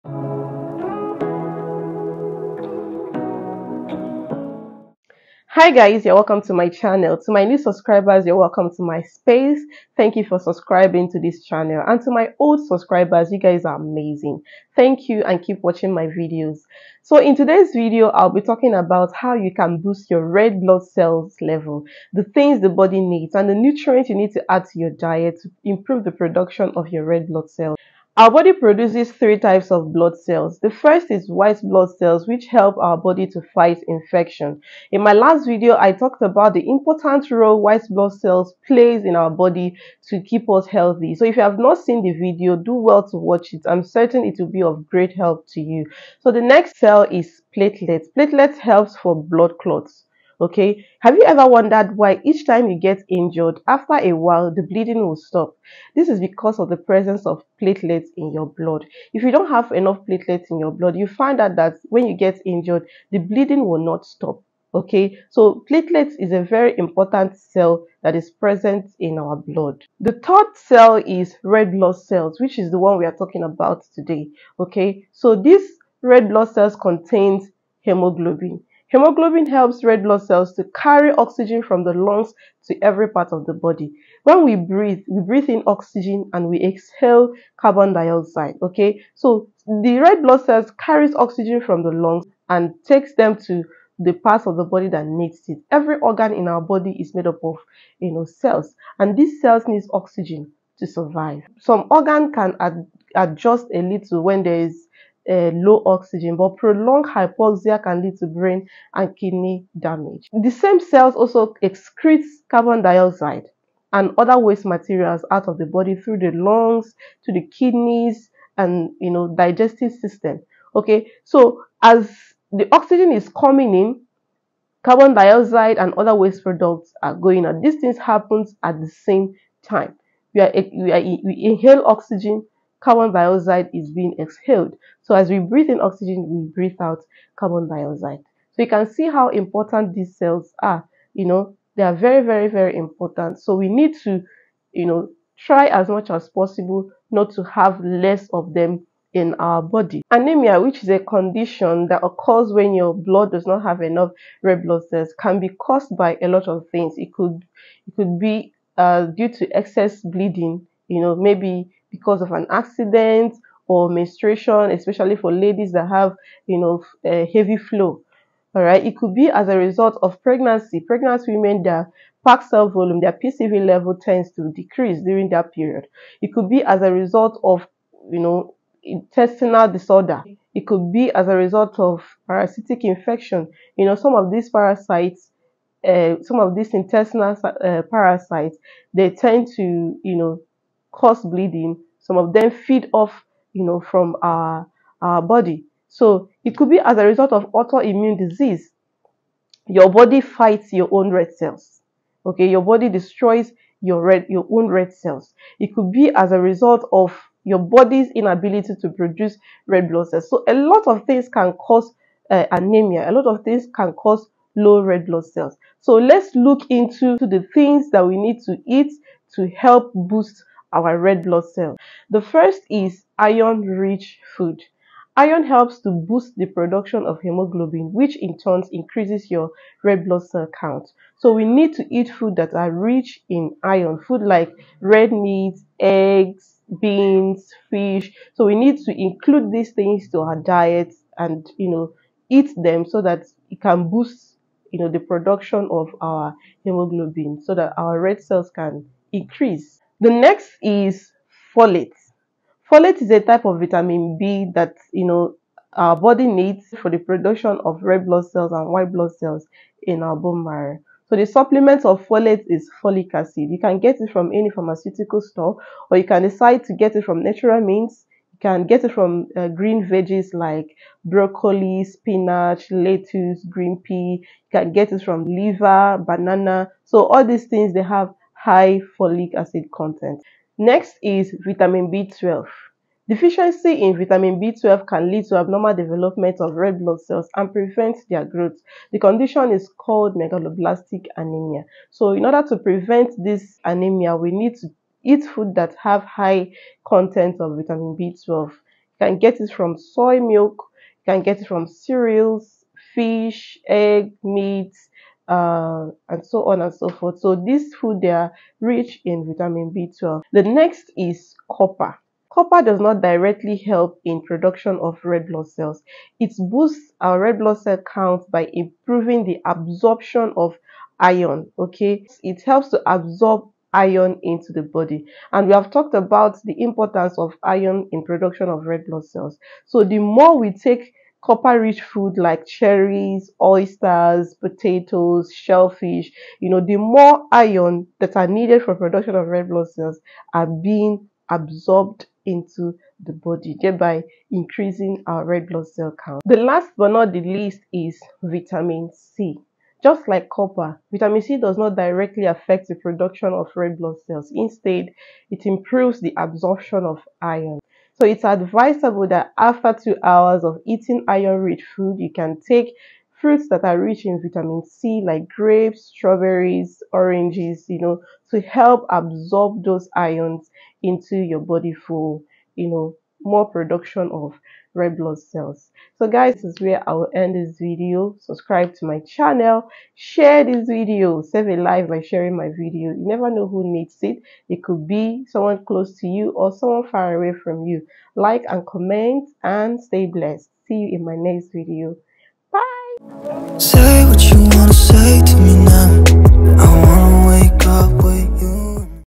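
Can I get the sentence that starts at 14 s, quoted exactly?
Thank you and keep watching my videos.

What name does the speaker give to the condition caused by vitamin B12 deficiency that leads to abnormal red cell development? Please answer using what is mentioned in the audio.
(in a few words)
megaloblastic anemia.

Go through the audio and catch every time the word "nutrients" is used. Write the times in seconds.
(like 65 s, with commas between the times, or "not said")
23 s.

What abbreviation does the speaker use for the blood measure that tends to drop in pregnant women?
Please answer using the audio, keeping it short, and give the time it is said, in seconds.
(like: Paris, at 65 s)
PCV, at 173 s.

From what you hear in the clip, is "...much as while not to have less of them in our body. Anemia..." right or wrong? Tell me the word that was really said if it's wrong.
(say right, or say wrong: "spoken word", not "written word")
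wrong: "possible", not "while".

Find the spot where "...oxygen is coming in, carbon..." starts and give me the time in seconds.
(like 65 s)
122 s.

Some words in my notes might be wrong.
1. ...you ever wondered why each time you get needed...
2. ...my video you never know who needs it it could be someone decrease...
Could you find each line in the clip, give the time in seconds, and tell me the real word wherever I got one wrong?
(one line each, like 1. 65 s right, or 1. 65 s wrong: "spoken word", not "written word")
1. 51 s wrong: "injured", not "needed"
2. 382 s wrong: "close", not "decrease".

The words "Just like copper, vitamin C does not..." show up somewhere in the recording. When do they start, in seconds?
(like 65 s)
349 s.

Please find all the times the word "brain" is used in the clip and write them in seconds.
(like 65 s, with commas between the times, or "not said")
108 s.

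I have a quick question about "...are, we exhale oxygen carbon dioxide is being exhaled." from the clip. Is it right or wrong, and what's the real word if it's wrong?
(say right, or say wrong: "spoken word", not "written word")
wrong: "inhale", not "exhale".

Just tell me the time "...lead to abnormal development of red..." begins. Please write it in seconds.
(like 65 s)
285 s.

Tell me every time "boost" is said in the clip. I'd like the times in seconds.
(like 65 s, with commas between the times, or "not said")
19 s, 219 s, 225 s, 243 s, 316 s.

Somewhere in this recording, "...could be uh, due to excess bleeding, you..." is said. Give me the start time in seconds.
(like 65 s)
157 s.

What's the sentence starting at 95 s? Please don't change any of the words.
Every organ in our body is made up of, you know, cells, and these cells needs oxygen to survive.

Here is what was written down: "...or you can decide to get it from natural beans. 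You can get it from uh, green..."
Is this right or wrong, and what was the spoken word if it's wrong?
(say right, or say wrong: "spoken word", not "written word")
wrong: "means", not "beans".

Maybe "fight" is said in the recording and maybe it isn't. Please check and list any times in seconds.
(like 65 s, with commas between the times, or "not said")
33 s, 200 s.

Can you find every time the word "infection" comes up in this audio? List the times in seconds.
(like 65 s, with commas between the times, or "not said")
33 s, 182 s.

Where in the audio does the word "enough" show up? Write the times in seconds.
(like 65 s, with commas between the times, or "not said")
59 s, 153 s.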